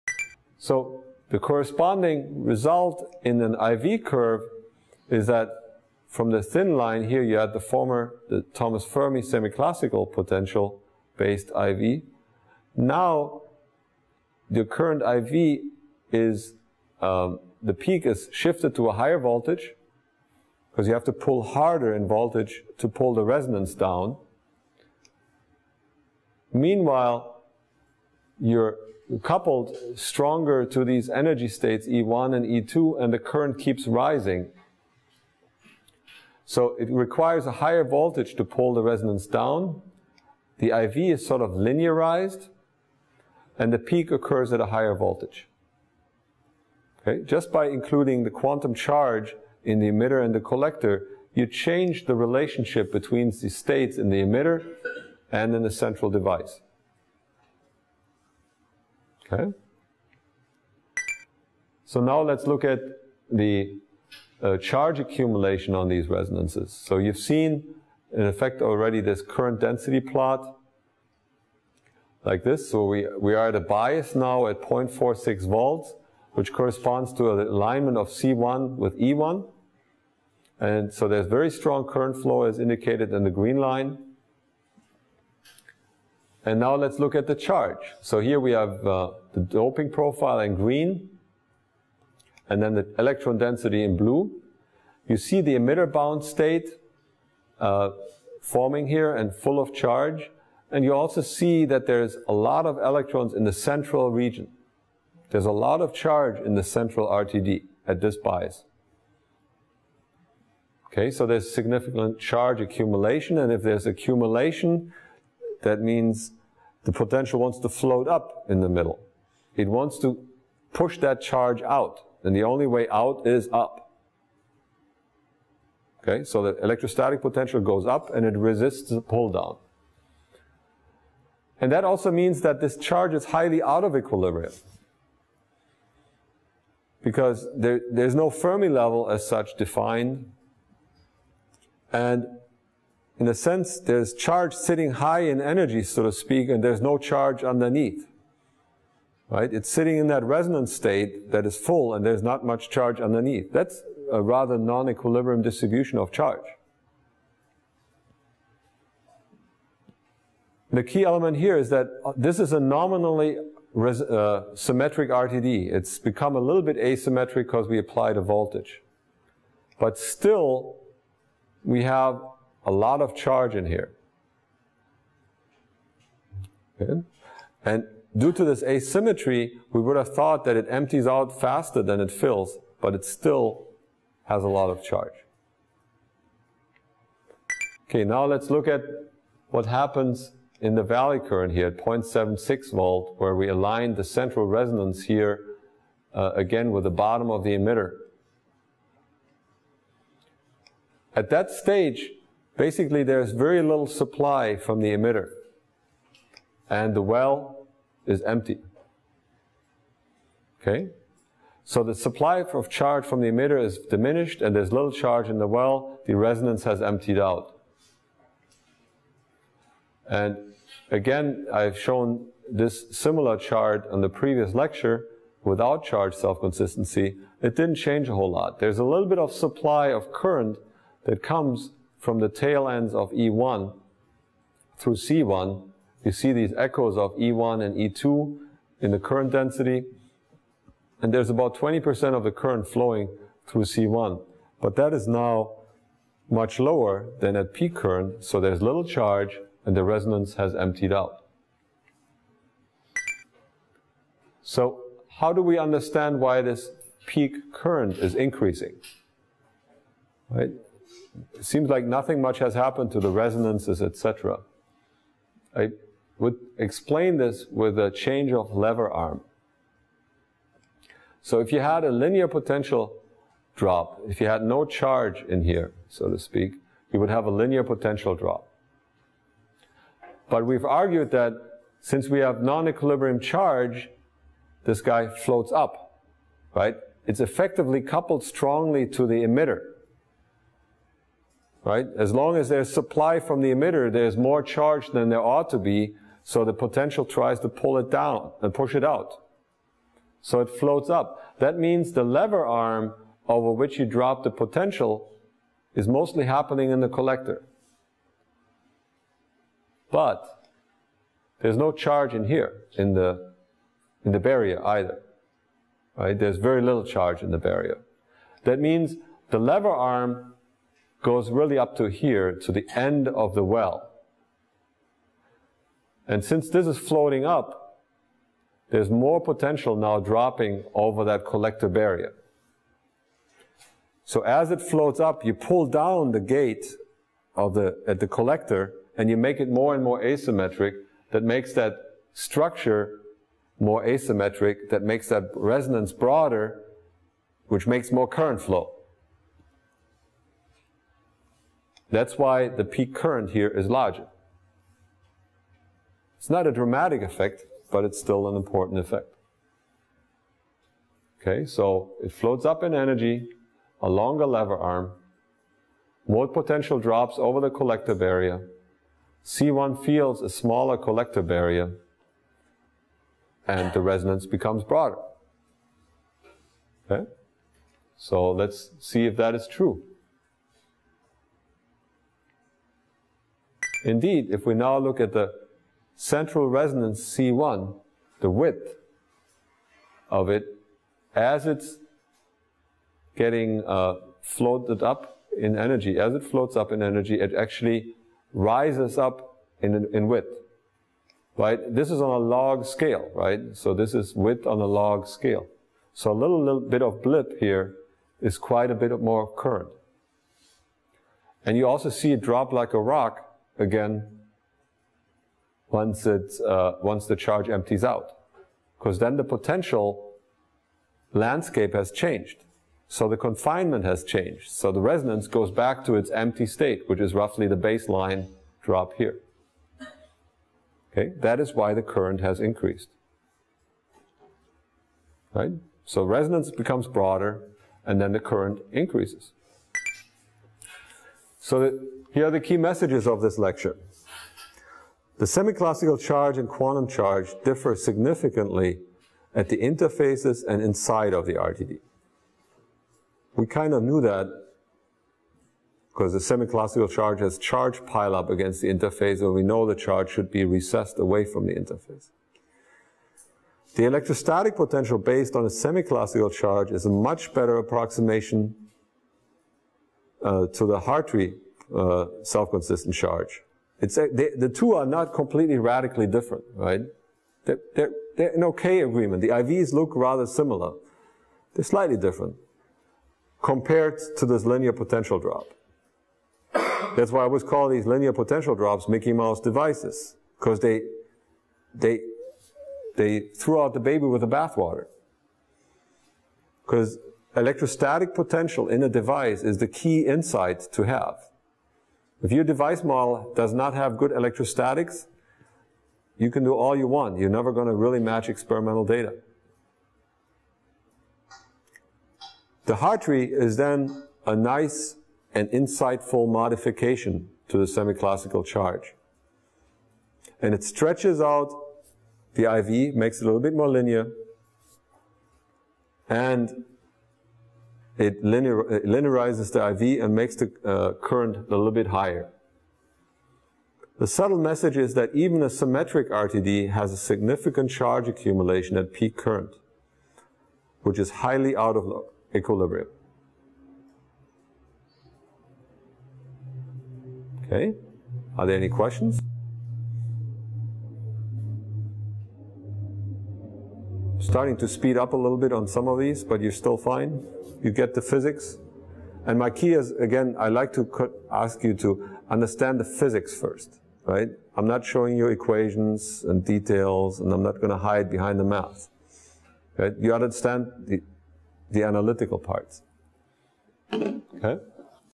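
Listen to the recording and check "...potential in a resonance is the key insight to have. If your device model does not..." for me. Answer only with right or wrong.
wrong.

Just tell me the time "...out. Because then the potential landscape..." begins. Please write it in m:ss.
6:57.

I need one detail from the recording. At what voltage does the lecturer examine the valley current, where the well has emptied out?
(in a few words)
0.76 volt.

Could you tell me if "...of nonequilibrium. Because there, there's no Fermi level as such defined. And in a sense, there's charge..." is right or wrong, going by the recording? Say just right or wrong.
wrong.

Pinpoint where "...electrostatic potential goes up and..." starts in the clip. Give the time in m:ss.
2:06.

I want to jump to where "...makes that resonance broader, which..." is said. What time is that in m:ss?
5:44.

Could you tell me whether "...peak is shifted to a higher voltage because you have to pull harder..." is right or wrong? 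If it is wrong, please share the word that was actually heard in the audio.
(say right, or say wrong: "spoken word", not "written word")
right.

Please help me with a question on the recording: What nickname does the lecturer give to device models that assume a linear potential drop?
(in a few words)
Mickey Mouse devices.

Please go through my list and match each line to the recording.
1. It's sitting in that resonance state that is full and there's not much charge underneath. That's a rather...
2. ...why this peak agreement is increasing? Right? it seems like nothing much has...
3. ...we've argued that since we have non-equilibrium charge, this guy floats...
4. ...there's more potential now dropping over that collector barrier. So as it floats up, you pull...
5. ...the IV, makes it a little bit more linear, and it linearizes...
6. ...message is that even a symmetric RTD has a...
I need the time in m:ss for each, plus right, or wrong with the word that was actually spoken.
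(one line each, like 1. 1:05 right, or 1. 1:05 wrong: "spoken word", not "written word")
1. 2:29 right
2. 4:16 wrong: "current", not "agreement"
3. 4:40 right
4. 5:28 right
5. 8:42 right
6. 8:54 right.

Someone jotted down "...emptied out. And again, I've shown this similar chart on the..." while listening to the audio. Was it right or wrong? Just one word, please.
right.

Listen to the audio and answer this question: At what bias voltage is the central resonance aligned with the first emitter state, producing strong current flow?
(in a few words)
0.46 volts.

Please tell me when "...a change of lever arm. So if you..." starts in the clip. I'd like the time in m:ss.
4:27.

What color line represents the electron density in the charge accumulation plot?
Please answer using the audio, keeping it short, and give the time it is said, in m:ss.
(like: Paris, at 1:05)
blue, at 1:32.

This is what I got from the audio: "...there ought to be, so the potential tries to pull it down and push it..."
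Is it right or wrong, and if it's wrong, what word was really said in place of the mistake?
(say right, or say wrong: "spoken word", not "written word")
right.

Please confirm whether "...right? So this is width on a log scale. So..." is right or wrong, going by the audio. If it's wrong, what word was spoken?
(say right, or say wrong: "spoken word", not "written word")
right.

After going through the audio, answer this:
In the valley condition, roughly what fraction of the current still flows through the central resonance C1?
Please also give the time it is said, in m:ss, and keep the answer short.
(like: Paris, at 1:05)
20%, at 4:01.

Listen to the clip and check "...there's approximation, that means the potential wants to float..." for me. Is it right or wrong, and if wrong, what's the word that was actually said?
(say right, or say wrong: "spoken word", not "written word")
wrong: "accumulation", not "approximation".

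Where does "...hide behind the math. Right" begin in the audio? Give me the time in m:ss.
9:27.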